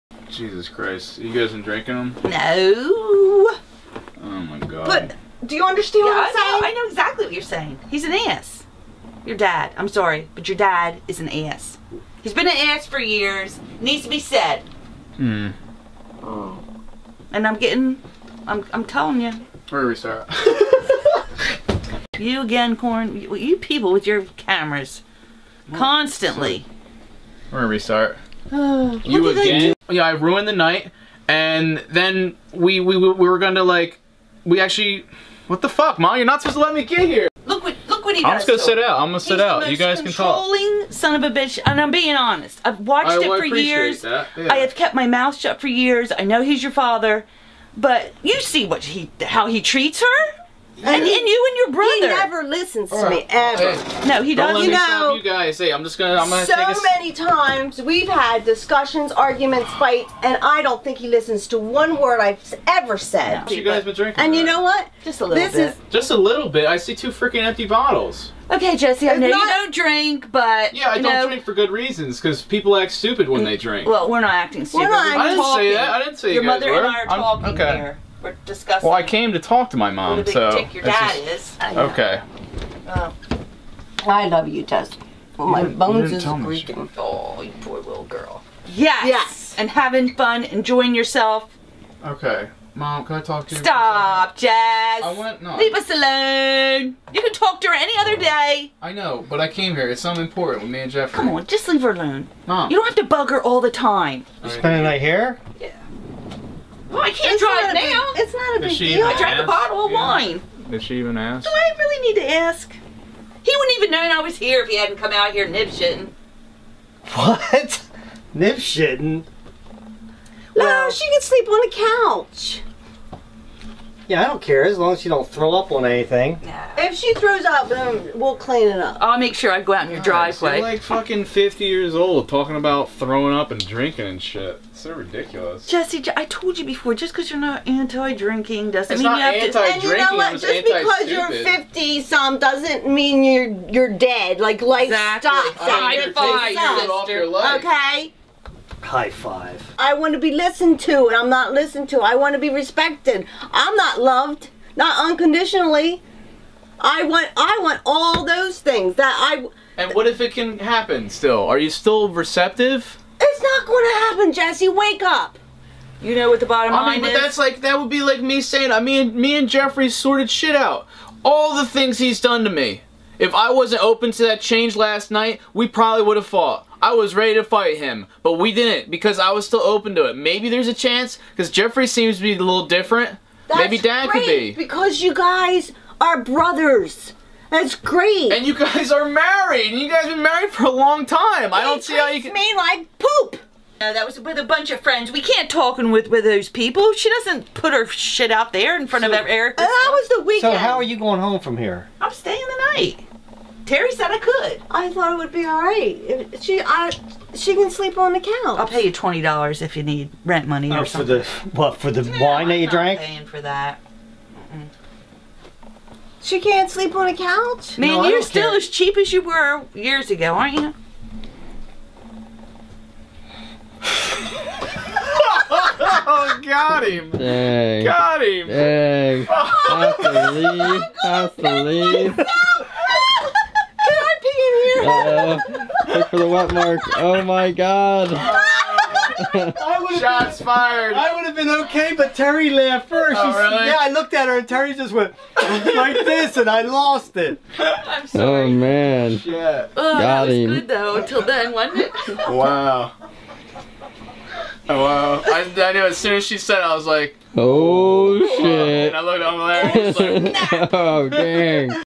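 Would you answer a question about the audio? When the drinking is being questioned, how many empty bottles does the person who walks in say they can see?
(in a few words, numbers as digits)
2.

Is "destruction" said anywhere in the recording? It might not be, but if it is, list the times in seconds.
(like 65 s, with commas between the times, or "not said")
not said.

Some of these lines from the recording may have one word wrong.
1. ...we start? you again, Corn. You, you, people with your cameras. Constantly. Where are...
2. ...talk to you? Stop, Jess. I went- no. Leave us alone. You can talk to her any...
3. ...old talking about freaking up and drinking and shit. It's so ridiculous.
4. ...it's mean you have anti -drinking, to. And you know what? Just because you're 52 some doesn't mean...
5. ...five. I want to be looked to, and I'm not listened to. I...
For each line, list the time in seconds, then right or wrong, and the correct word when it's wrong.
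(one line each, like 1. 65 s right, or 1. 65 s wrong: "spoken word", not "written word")
1. 19 s right
2. 93 s right
3. 131 s wrong: "throwing", not "freaking"
4. 138 s wrong: "50", not "52"
5. 149 s wrong: "listened", not "looked".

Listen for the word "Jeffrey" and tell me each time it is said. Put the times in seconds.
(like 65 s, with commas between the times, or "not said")
100 s, 169 s, 181 s.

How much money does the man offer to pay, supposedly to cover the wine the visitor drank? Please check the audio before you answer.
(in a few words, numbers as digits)
$20.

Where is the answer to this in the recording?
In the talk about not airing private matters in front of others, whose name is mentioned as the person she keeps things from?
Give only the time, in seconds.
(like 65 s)
199 s.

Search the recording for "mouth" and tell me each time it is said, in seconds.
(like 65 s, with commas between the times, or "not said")
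45 s.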